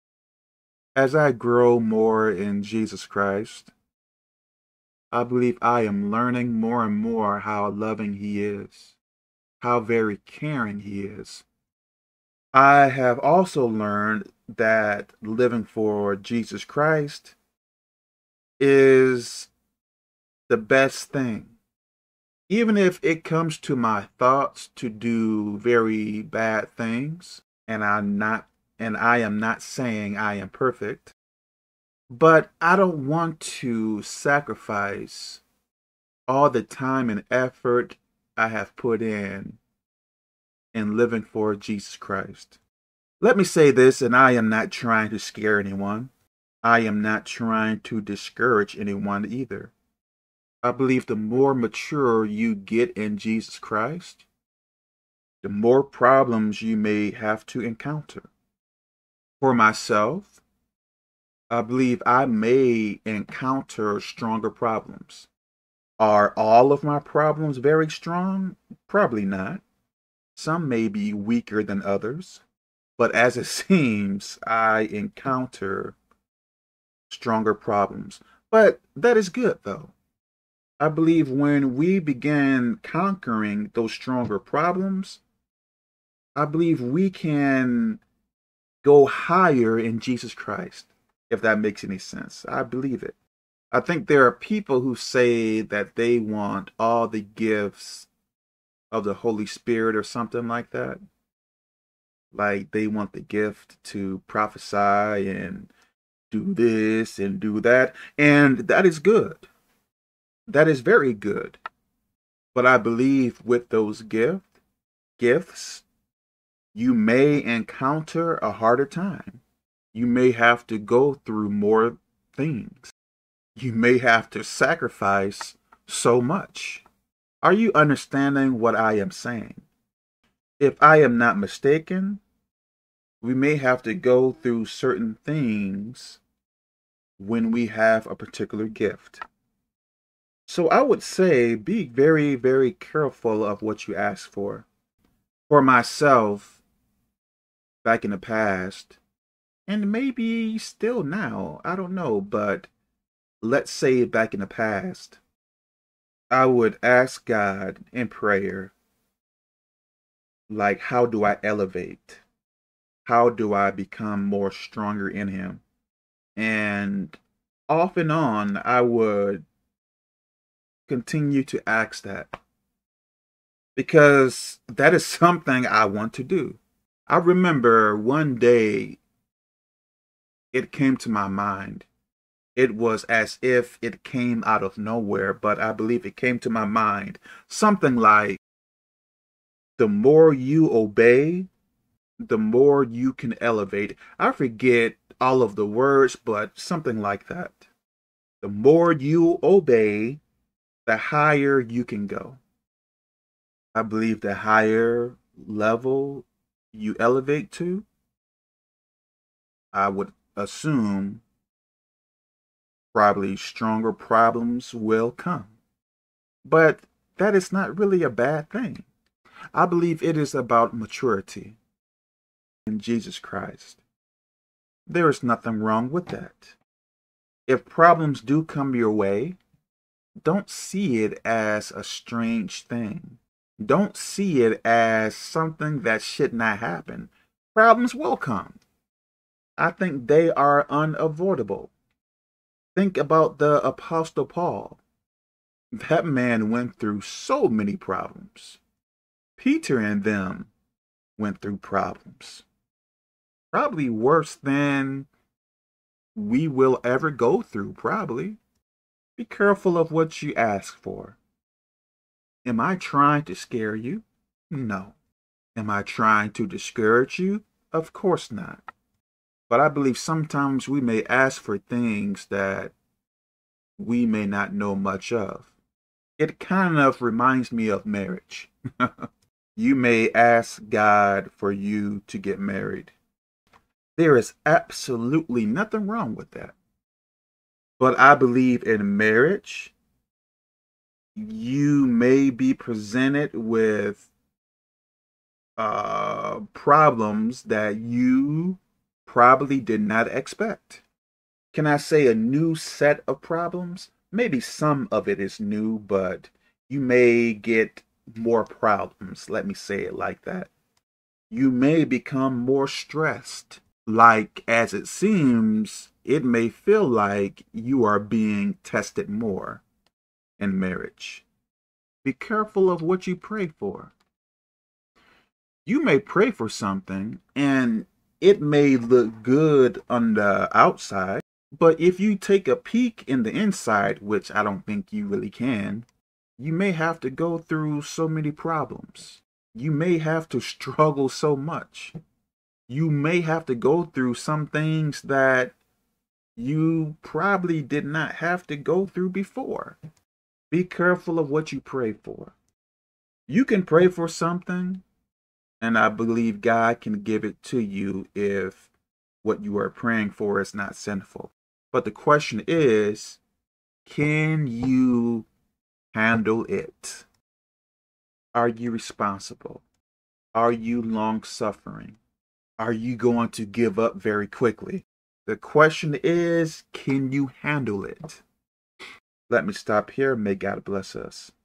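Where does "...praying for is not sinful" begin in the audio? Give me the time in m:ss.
5:59.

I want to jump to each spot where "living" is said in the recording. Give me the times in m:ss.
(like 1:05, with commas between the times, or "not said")
0:15, 0:40.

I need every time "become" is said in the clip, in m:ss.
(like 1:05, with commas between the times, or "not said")
2:43, 5:11.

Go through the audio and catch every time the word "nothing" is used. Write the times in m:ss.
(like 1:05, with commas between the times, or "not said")
3:45, 4:45.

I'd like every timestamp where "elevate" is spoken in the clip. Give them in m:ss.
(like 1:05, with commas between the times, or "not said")
2:41, 3:13, 3:26.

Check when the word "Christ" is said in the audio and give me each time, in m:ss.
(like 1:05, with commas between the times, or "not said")
0:03, 0:16, 0:41, 0:53, 1:30, 3:43.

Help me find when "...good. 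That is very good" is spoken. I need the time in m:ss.
1:48.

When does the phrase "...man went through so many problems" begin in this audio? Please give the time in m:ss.
4:06.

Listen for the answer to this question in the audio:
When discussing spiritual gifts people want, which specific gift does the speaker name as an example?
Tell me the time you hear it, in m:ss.
1:44.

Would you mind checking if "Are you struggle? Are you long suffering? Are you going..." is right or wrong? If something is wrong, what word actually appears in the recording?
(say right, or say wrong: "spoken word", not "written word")
wrong: "responsible", not "struggle".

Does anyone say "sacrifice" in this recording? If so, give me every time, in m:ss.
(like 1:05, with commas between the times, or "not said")
0:34, 2:04.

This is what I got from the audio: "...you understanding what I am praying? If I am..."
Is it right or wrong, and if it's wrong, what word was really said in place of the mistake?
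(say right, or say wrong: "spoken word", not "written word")
wrong: "saying", not "praying".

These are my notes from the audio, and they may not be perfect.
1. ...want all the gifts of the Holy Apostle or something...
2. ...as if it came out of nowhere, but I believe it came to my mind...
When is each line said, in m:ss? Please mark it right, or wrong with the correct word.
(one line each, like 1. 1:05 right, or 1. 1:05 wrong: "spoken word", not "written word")
1. 1:36 wrong: "Spirit", not "Apostle"
2. 3:03 right.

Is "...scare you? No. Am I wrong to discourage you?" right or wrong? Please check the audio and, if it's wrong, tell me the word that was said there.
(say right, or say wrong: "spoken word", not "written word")
wrong: "trying", not "wrong".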